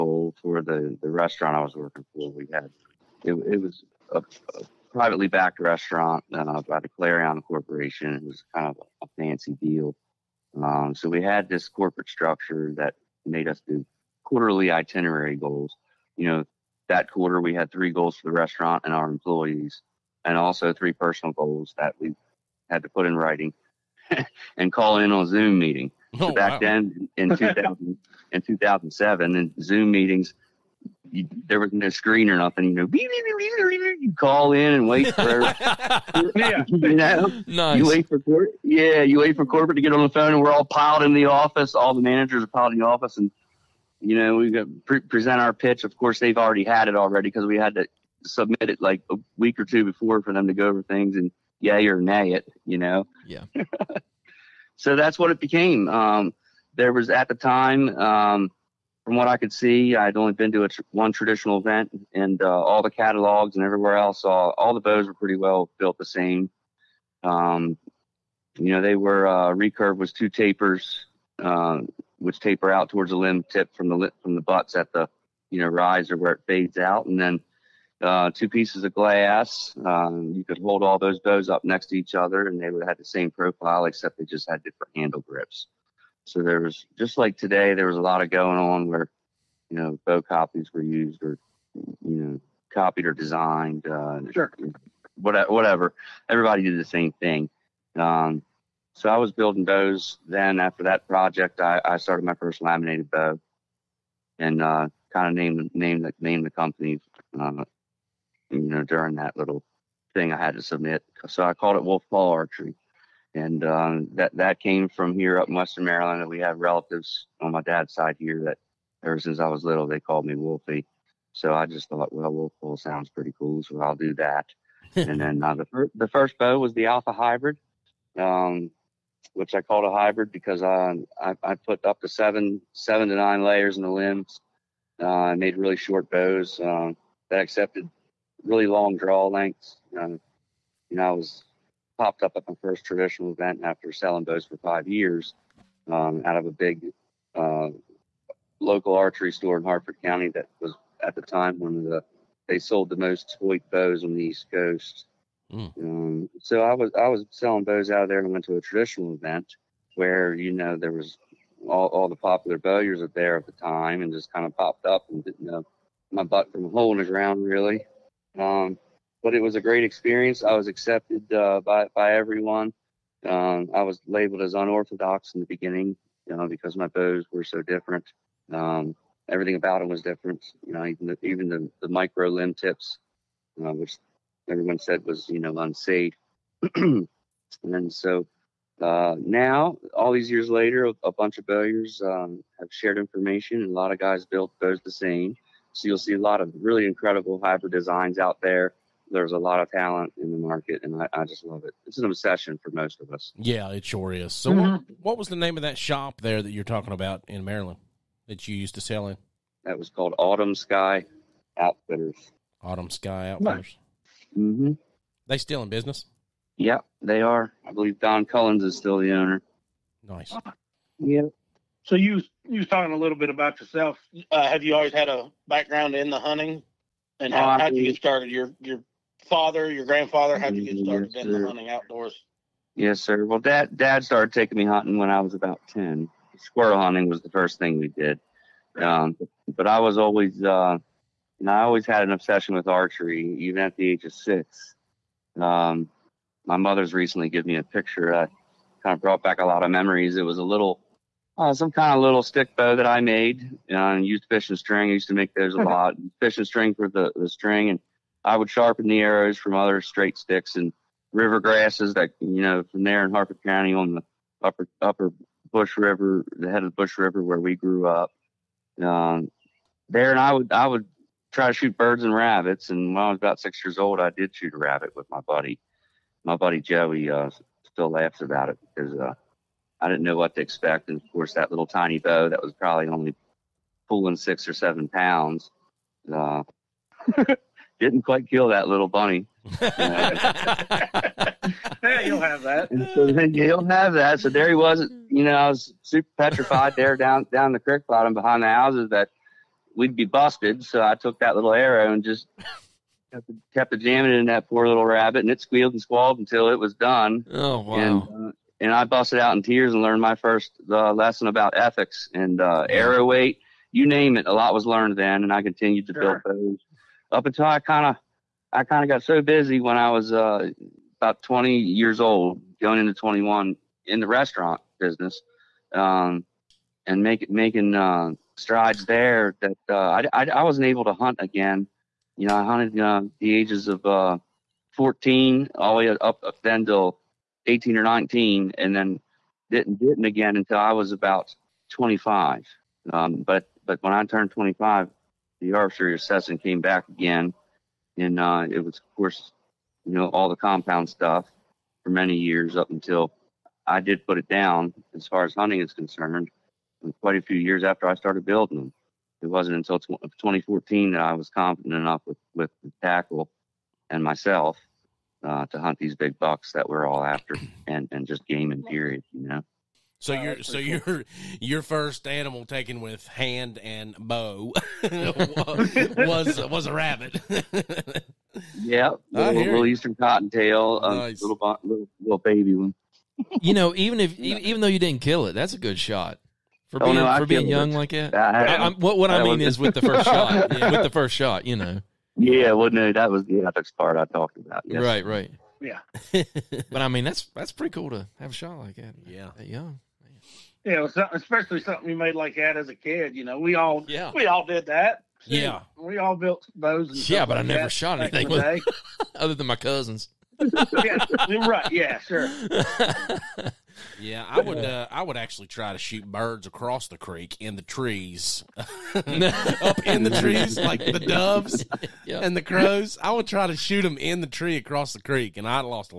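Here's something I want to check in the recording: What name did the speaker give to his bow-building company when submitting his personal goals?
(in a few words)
Wolf Paw Archery.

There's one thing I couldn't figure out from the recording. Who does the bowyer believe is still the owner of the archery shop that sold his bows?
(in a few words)
Don Cullins.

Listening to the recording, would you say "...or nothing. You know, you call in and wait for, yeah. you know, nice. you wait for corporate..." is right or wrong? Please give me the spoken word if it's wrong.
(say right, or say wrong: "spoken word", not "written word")
right.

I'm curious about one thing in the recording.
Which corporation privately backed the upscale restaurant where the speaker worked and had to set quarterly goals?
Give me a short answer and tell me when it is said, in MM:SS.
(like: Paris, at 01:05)
Clarion Corporation, at 00:06.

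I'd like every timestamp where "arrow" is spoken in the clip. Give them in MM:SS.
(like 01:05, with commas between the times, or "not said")
04:18, 05:01, 05:12.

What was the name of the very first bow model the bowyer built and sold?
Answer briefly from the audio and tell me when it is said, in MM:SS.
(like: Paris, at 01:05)
Alpha Hybrid, at 02:06.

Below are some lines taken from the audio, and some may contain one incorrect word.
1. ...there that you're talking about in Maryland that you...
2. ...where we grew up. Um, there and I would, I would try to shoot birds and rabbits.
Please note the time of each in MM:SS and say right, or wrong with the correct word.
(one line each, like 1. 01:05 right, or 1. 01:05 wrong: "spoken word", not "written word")
1. 03:26 right
2. 04:27 right.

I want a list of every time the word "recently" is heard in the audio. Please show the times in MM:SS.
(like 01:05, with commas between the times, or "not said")
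04:06.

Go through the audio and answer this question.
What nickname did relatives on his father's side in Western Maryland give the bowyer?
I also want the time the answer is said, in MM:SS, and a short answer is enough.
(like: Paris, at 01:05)
Wolfie, at 02:00.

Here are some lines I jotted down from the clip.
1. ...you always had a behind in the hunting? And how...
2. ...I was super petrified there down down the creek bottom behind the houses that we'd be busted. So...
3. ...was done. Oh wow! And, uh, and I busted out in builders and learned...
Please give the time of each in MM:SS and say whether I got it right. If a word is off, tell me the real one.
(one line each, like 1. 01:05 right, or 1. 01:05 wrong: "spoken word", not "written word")
1. 03:44 wrong: "background", not "behind"
2. 04:55 right
3. 05:06 wrong: "tears", not "builders".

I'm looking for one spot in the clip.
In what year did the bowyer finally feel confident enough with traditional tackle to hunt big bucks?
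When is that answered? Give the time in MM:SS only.
06:00.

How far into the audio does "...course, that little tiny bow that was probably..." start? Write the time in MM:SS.
04:41.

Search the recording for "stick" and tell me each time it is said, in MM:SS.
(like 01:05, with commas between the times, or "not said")
04:12, 04:20.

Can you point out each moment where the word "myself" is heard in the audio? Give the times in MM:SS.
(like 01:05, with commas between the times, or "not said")
06:04.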